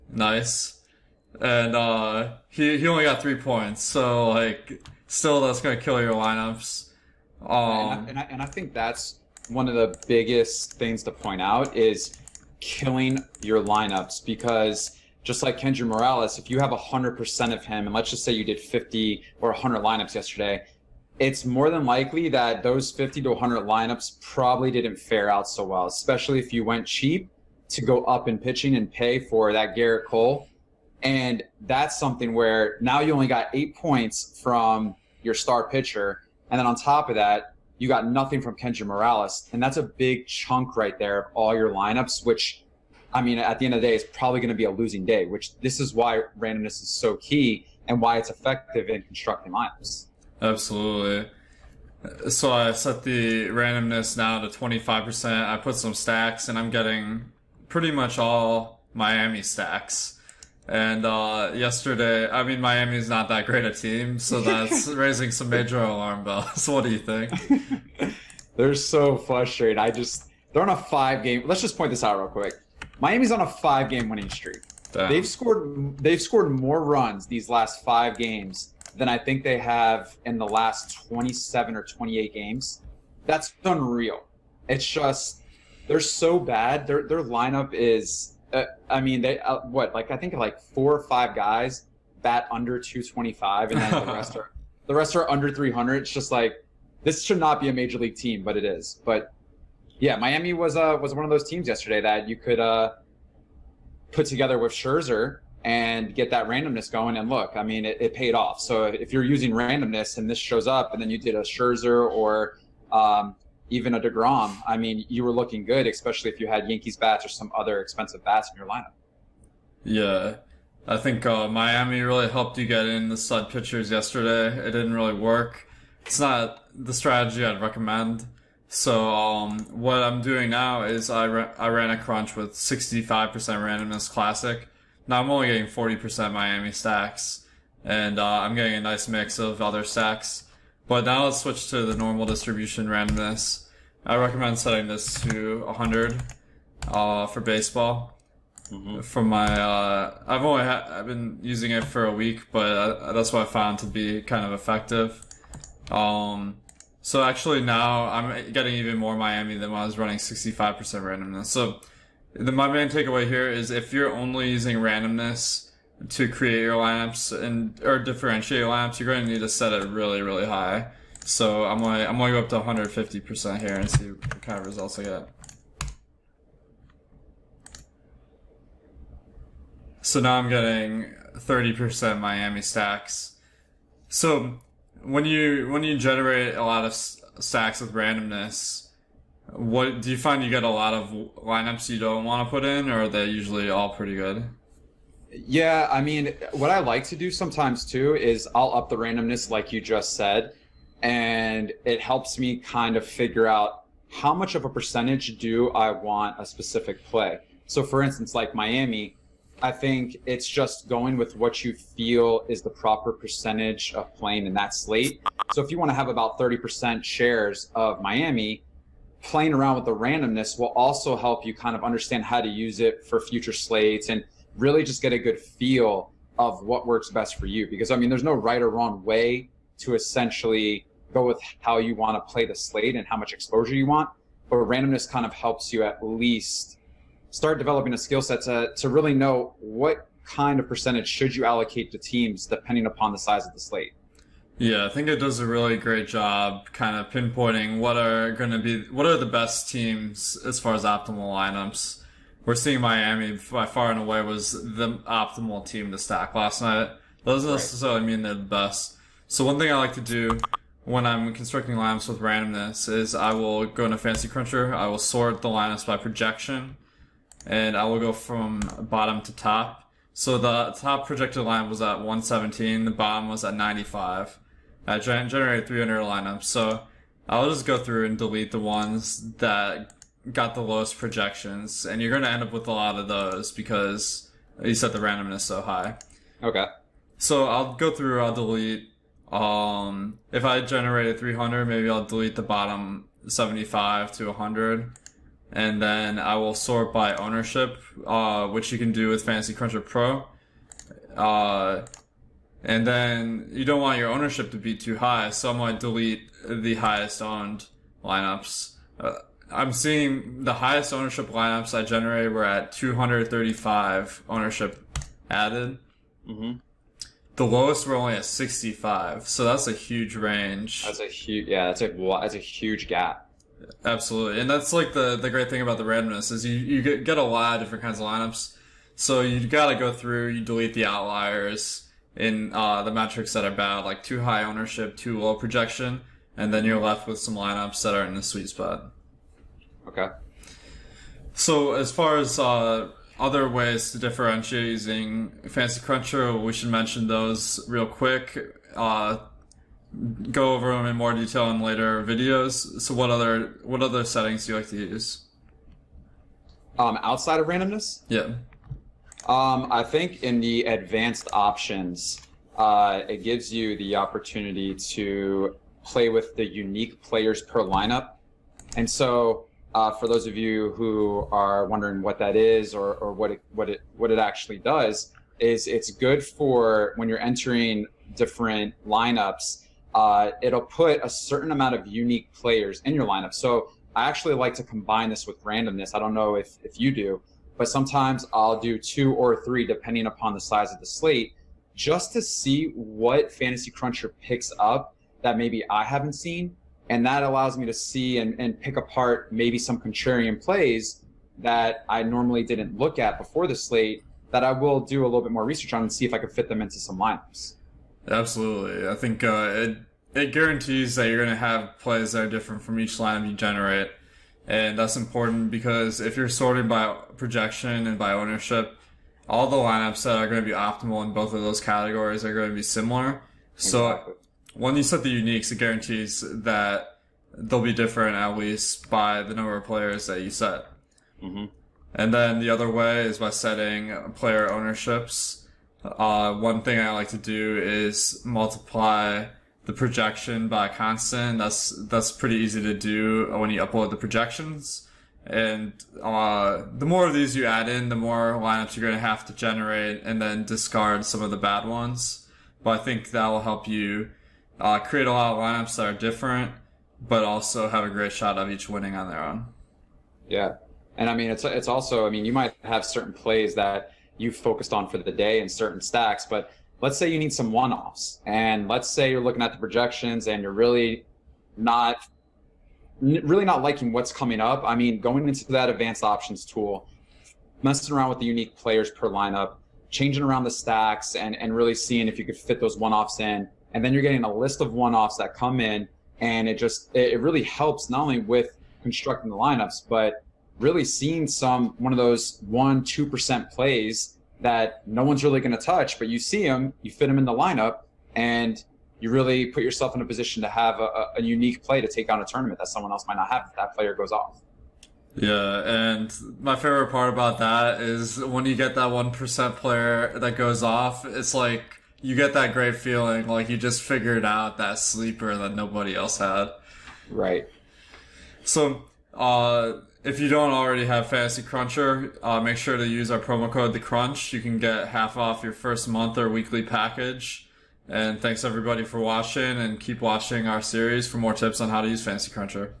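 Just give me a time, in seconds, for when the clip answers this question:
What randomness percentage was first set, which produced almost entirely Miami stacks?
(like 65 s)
54 s.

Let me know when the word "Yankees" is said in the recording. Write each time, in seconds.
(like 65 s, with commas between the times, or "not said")
116 s.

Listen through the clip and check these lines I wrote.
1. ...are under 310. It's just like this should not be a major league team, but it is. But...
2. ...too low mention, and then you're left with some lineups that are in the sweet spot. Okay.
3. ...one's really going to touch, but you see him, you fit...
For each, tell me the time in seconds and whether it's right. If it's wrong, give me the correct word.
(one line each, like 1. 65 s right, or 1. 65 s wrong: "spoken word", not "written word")
1. 95 s wrong: "300", not "310"
2. 334 s wrong: "projection", not "mention"
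3. 495 s right.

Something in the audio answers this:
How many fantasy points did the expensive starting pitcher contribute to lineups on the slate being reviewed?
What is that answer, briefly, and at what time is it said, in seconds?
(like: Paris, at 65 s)
8, at 33 s.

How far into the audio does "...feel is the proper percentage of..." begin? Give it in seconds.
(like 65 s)
211 s.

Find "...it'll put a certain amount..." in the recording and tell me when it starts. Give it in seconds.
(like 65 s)
380 s.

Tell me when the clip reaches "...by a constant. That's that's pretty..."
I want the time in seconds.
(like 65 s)
440 s.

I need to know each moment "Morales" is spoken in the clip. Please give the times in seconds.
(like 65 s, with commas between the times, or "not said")
15 s, 38 s.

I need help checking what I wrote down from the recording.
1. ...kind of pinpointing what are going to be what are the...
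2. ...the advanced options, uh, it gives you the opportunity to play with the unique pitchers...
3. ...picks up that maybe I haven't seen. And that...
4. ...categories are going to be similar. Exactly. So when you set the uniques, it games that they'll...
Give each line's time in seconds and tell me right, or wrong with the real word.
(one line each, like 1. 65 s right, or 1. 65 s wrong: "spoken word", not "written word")
1. 246 s right
2. 360 s wrong: "players", not "pitchers"
3. 394 s right
4. 421 s wrong: "guarantees", not "games".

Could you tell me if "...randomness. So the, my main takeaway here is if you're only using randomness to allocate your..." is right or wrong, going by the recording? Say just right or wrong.
wrong.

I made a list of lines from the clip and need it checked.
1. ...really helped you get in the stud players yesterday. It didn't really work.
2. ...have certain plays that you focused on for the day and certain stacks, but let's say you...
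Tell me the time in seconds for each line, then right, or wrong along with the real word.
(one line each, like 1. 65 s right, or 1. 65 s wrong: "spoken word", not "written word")
1. 122 s wrong: "pitchers", not "players"
2. 462 s right.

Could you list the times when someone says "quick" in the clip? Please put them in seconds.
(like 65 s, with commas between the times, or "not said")
72 s, 347 s.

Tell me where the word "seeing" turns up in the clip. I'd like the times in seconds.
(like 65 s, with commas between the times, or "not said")
252 s, 309 s, 481 s, 490 s.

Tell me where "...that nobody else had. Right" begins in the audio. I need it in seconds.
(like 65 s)
515 s.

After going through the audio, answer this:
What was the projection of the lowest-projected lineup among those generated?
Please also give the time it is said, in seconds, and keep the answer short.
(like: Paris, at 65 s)
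95, at 273 s.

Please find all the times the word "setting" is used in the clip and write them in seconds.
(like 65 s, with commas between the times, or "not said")
144 s, 354 s, 433 s.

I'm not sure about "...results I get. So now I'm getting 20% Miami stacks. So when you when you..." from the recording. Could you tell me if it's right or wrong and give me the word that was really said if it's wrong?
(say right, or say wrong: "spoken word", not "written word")
wrong: "30", not "20".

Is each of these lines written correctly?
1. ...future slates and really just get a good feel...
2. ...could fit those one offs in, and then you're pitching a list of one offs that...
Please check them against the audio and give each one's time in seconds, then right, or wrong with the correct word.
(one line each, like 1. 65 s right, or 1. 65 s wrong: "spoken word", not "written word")
1. 223 s right
2. 482 s wrong: "getting", not "pitching".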